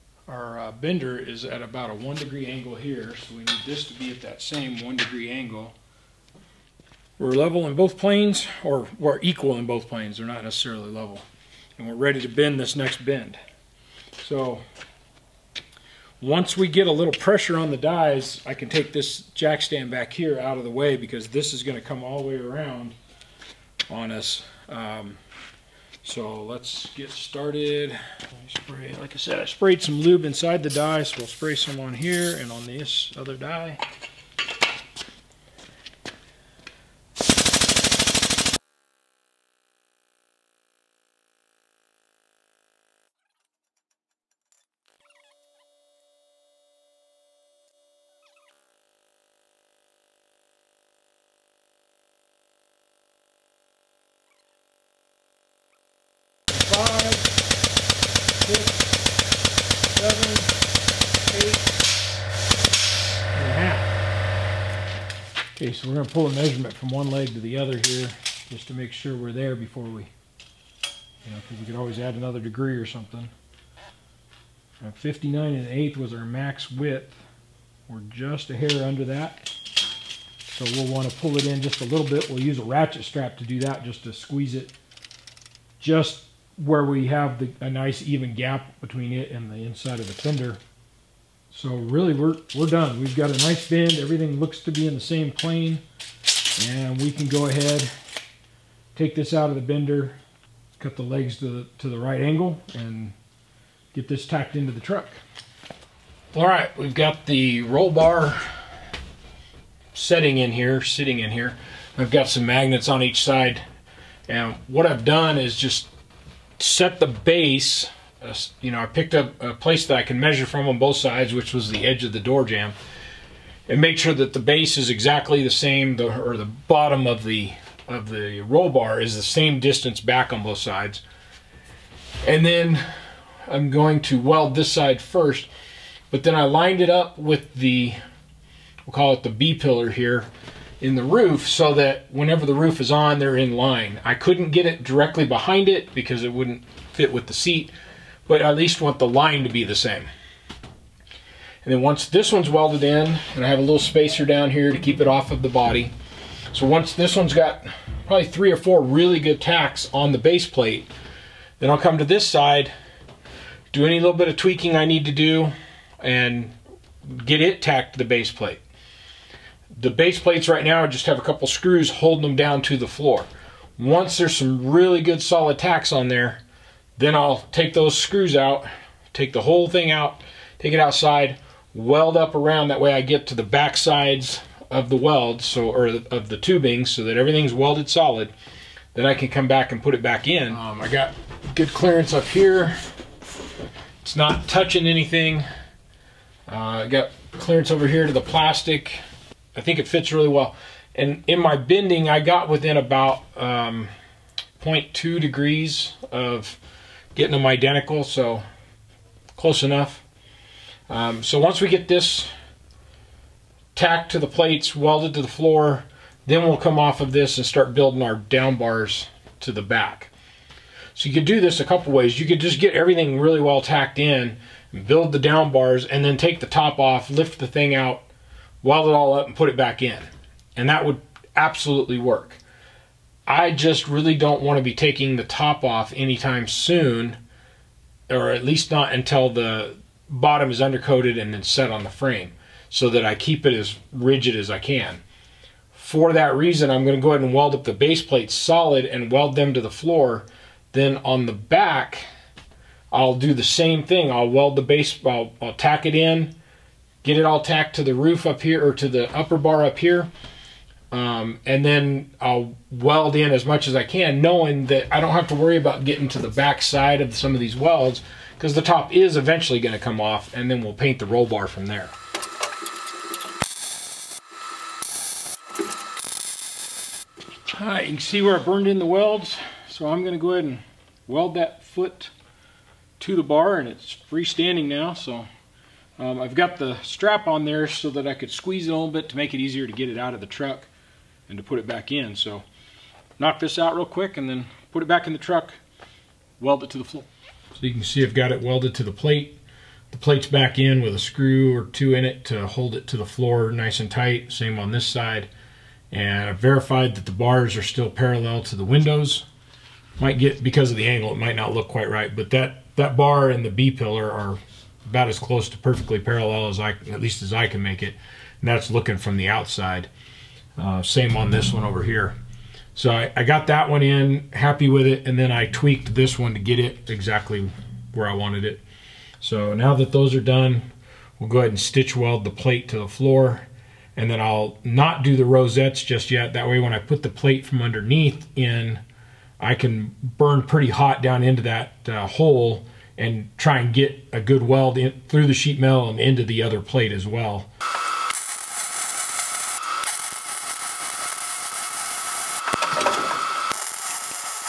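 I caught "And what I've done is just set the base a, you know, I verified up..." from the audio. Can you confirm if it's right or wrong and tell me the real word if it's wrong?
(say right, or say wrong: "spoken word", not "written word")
wrong: "picked", not "verified".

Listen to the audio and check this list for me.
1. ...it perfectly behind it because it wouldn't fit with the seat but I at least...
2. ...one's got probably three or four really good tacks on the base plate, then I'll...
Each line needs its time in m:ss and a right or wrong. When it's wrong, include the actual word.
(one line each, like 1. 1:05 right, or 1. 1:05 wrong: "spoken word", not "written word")
1. 2:24 wrong: "directly", not "perfectly"
2. 2:37 right.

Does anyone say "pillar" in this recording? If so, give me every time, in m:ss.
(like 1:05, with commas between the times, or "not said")
2:19, 5:13.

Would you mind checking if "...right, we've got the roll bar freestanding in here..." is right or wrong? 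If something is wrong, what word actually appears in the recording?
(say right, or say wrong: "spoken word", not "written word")
wrong: "setting", not "freestanding".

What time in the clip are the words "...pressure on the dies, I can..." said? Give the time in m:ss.
0:17.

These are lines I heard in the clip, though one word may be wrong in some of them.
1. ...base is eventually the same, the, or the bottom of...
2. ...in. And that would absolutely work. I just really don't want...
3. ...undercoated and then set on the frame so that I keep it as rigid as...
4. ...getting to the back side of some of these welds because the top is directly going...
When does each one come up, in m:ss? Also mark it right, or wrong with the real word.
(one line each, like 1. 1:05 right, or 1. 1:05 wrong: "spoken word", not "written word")
1. 2:04 wrong: "exactly", not "eventually"
2. 3:49 right
3. 4:00 right
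4. 4:25 wrong: "eventually", not "directly".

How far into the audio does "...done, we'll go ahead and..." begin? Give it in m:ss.
5:30.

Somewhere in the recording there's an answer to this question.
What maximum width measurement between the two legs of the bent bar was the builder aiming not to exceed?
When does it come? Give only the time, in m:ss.
1:14.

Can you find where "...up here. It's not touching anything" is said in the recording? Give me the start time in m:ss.
3:12.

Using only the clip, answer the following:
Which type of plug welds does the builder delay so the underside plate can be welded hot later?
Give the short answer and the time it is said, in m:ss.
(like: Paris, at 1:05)
Rosettes, at 5:35.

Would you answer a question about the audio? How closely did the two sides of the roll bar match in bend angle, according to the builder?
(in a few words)
0.2 degrees.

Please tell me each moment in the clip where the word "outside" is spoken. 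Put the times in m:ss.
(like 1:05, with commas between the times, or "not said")
3:00, 5:19.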